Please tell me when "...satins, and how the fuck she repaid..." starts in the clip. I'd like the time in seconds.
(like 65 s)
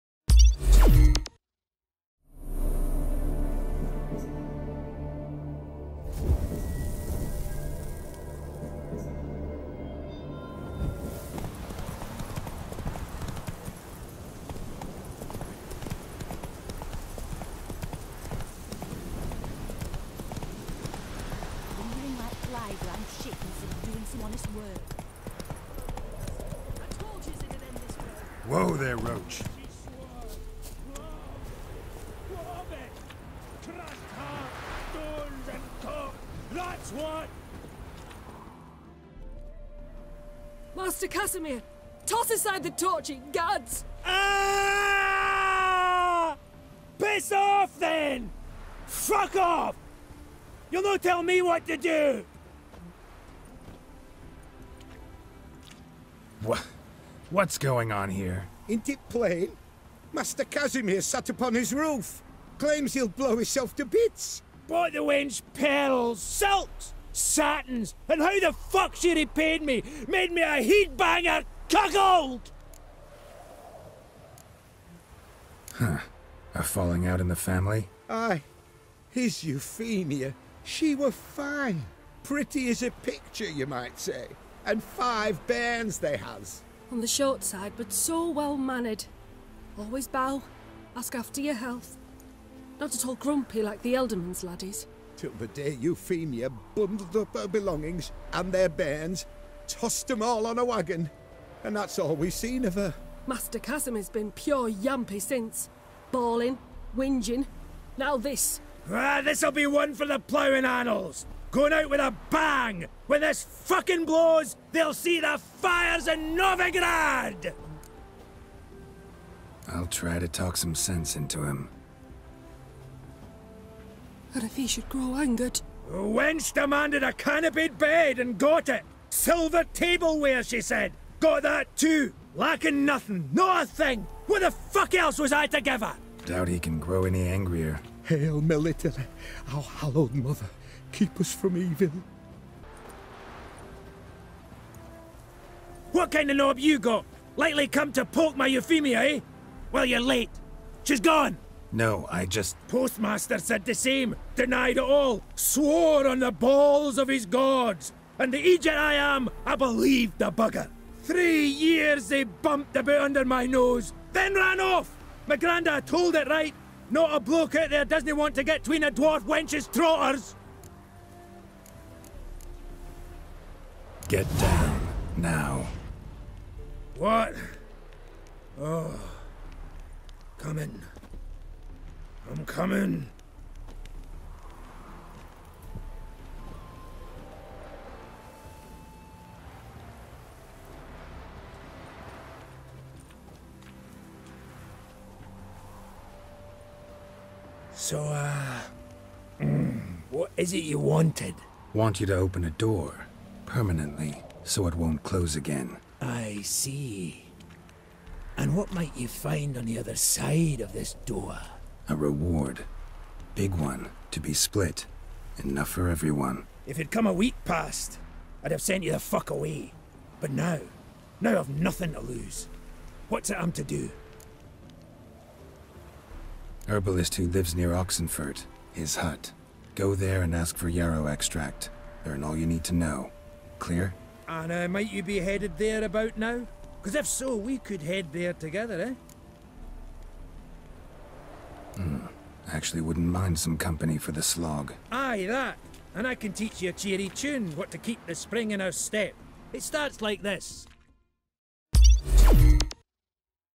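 67 s.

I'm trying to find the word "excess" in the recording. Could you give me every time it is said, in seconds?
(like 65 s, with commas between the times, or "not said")
not said.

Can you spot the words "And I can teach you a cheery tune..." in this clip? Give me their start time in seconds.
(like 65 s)
245 s.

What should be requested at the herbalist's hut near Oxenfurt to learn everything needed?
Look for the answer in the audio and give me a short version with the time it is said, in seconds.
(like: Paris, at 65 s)
Yarrow extract, at 230 s.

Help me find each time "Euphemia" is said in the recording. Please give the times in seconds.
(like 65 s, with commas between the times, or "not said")
79 s, 95 s, 148 s.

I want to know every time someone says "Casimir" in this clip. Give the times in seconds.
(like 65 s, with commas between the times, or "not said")
41 s, 60 s, 103 s.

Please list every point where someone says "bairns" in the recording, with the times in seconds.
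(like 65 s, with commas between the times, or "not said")
85 s, 98 s.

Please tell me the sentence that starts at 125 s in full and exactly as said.
The wench demanded a canopied bed and got it.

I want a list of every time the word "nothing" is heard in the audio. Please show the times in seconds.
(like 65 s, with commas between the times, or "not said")
132 s, 221 s.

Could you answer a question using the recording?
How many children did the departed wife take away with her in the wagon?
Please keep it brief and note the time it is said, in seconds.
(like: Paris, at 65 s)
5, at 84 s.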